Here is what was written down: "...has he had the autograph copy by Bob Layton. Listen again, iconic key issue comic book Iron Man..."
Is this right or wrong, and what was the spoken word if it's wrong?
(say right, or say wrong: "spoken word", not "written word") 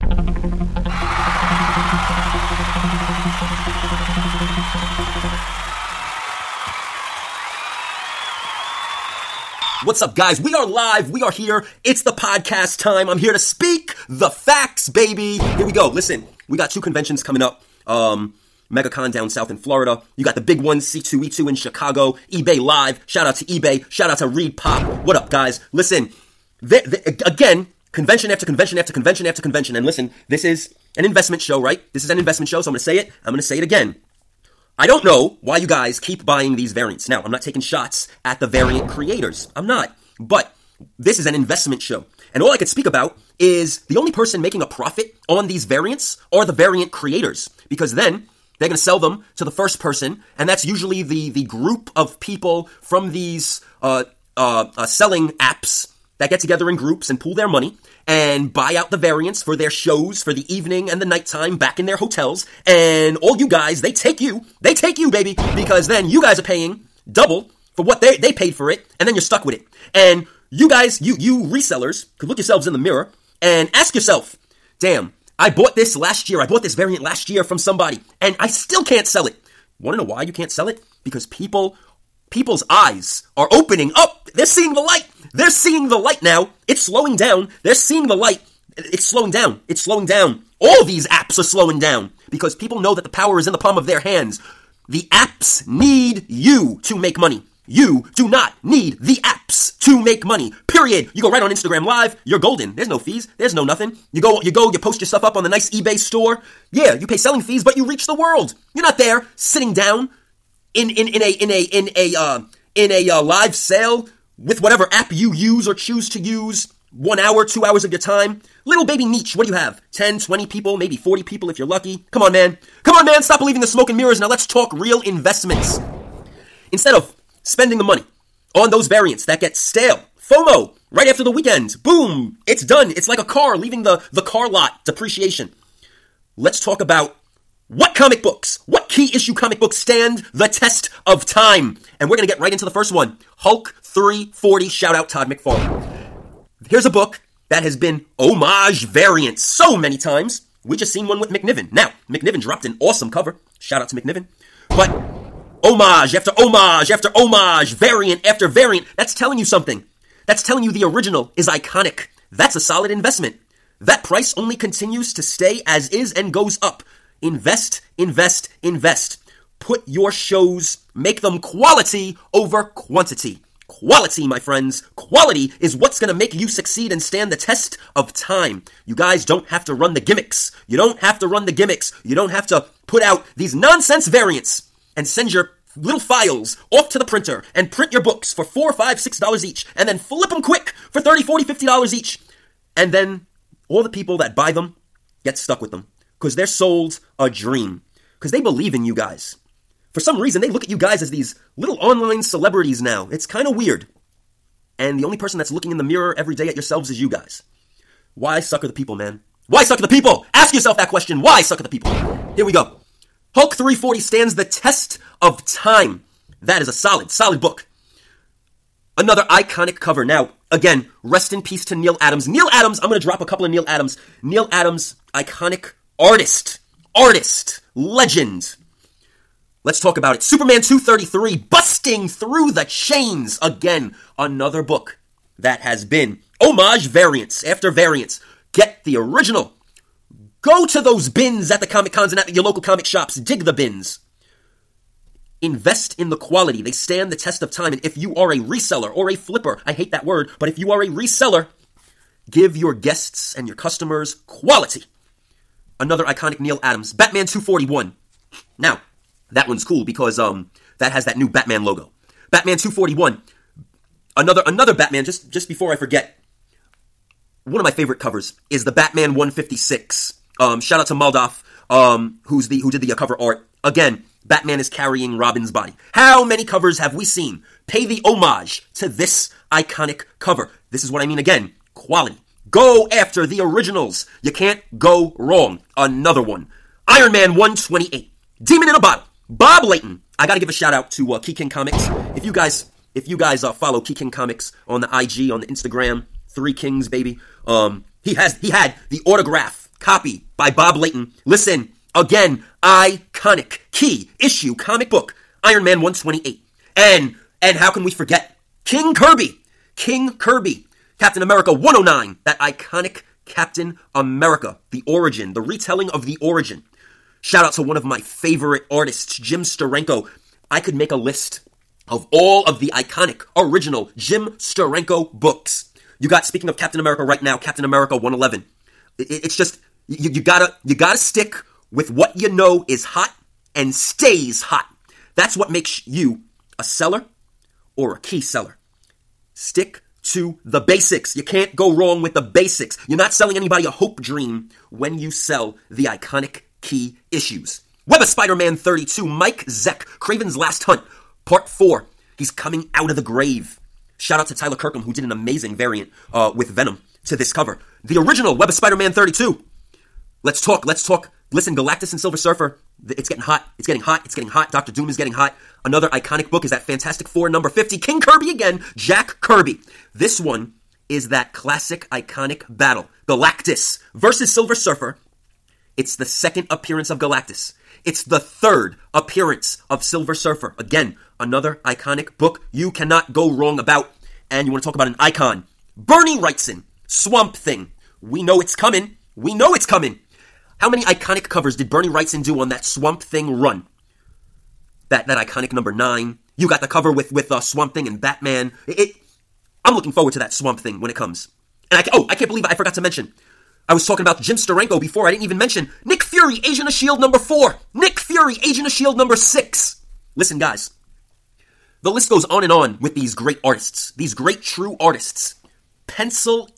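right.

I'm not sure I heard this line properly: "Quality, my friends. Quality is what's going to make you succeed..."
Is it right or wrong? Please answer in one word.
right.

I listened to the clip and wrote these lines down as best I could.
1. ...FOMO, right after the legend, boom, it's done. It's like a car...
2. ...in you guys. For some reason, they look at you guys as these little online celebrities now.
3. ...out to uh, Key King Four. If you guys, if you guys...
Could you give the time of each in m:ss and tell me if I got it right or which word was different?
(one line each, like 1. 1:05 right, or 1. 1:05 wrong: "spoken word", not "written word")
1. 2:10 wrong: "weekend", not "legend"
2. 3:18 right
3. 4:50 wrong: "Comics", not "Four".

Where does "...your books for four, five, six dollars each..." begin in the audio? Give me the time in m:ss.
3:07.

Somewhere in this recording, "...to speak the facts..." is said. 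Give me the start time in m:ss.
0:13.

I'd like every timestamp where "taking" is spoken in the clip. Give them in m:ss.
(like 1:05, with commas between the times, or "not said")
0:37.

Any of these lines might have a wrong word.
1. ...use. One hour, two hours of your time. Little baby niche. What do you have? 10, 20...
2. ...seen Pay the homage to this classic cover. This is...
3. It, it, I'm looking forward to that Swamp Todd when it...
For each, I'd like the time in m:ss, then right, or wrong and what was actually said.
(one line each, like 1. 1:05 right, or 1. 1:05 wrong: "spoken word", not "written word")
1. 1:56 right
2. 4:37 wrong: "iconic", not "classic"
3. 6:38 wrong: "Thing", not "Todd".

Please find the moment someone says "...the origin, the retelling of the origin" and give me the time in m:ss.
5:14.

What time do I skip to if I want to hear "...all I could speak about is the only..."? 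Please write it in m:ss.
0:42.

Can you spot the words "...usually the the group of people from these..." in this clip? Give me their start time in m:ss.
0:50.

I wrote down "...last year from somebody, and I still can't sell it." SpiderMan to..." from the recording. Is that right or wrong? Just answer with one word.
wrong.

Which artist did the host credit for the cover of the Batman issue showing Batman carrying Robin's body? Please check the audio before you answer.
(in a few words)
Moldoff.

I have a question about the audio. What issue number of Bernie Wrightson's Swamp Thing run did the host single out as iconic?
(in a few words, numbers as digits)
9.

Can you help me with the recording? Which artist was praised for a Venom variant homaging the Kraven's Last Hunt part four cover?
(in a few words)
Tyler Kirkham.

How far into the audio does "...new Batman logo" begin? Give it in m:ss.
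4:21.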